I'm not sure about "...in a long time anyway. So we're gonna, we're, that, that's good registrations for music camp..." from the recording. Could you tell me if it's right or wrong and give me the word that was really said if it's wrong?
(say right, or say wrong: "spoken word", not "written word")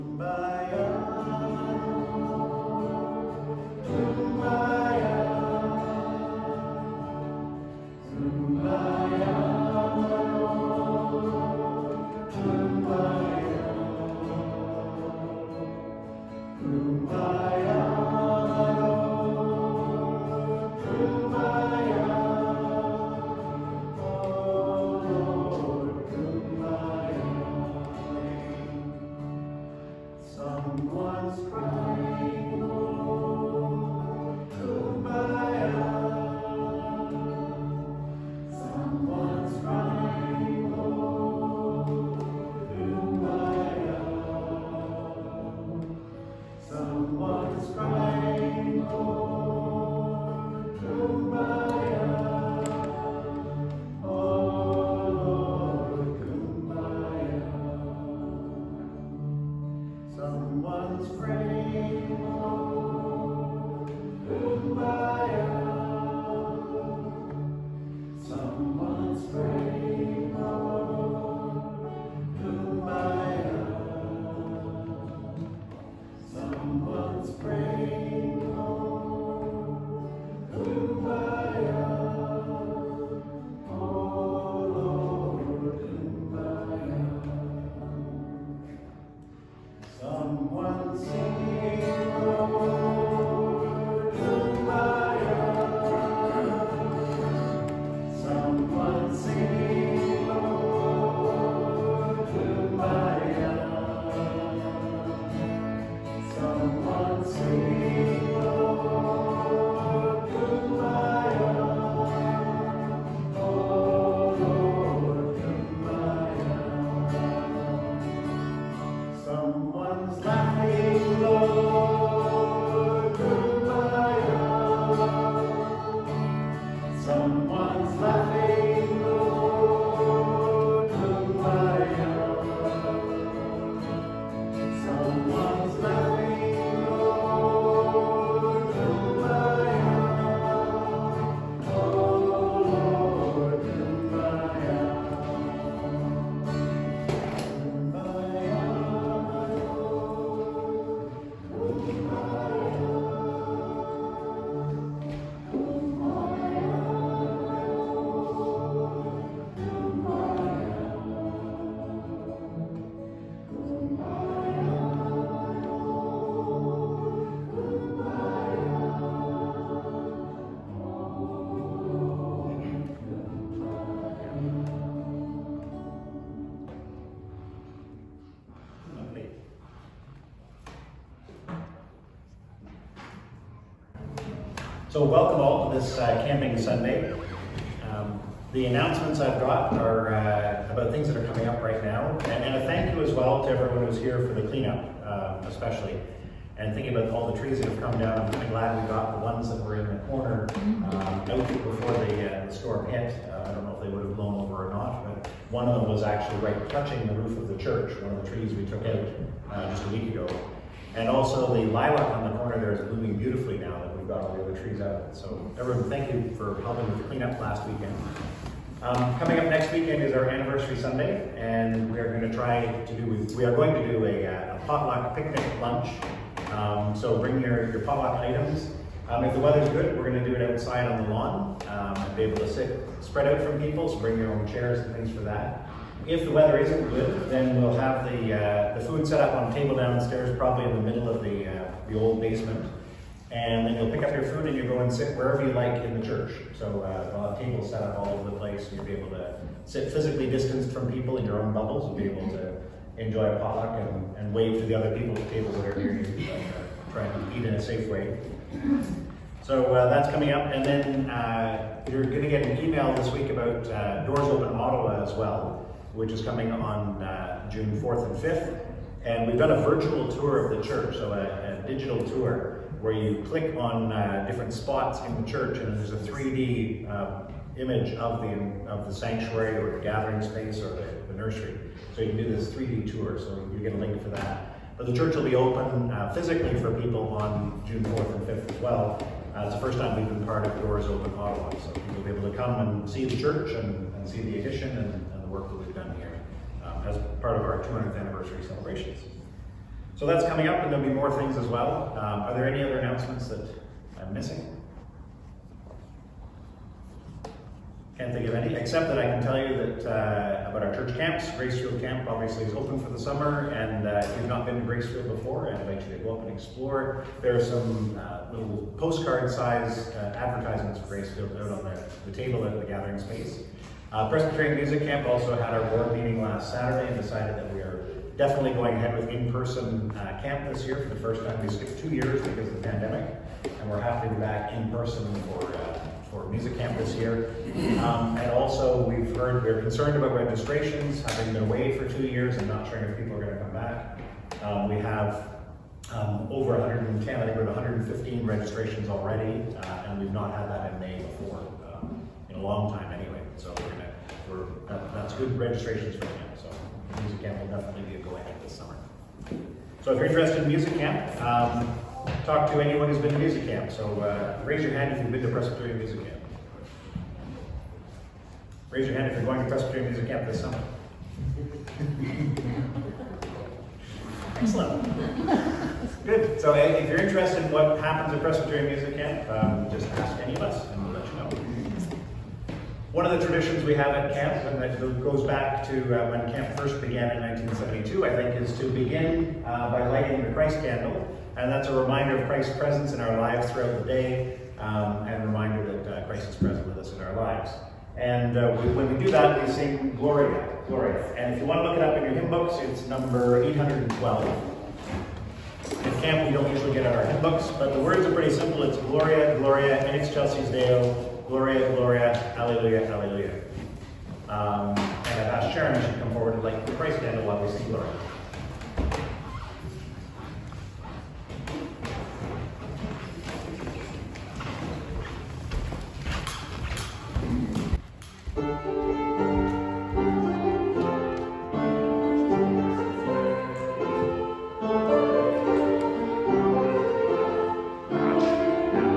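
right.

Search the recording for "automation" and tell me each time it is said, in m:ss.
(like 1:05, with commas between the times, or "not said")
not said.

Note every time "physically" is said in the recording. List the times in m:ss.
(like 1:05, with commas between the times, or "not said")
4:09, 4:46.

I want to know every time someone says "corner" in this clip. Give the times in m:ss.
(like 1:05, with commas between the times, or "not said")
3:20, 3:32.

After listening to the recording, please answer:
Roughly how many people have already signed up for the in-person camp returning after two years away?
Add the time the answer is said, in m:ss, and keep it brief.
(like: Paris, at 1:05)
115, at 5:47.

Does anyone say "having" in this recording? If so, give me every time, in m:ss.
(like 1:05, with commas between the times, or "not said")
5:41.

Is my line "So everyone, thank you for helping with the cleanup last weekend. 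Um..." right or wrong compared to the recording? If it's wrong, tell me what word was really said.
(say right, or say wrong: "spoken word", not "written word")
right.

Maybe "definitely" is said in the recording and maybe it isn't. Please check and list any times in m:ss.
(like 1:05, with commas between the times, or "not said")
5:28, 5:57.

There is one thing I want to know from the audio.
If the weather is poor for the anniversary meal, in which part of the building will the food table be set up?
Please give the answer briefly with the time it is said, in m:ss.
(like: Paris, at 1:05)
the old basement, at 4:01.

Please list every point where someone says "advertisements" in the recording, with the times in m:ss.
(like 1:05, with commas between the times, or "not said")
5:20.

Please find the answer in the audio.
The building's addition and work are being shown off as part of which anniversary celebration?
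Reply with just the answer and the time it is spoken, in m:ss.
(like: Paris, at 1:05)
200th, at 4:57.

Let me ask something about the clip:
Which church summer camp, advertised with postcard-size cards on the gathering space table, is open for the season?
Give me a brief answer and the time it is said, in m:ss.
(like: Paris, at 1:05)
Gracefield Camp, at 5:11.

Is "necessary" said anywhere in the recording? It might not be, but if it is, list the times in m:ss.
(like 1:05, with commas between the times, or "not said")
not said.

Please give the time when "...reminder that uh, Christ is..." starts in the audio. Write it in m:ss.
6:35.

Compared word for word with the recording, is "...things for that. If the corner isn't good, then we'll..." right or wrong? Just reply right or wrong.
wrong.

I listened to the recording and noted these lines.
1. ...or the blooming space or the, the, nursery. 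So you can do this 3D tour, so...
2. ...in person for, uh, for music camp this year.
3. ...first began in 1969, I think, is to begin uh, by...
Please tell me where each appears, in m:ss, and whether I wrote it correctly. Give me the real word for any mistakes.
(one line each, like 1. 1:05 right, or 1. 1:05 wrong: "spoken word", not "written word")
1. 4:39 wrong: "gathering", not "blooming"
2. 5:34 right
3. 6:26 wrong: "1972", not "1969".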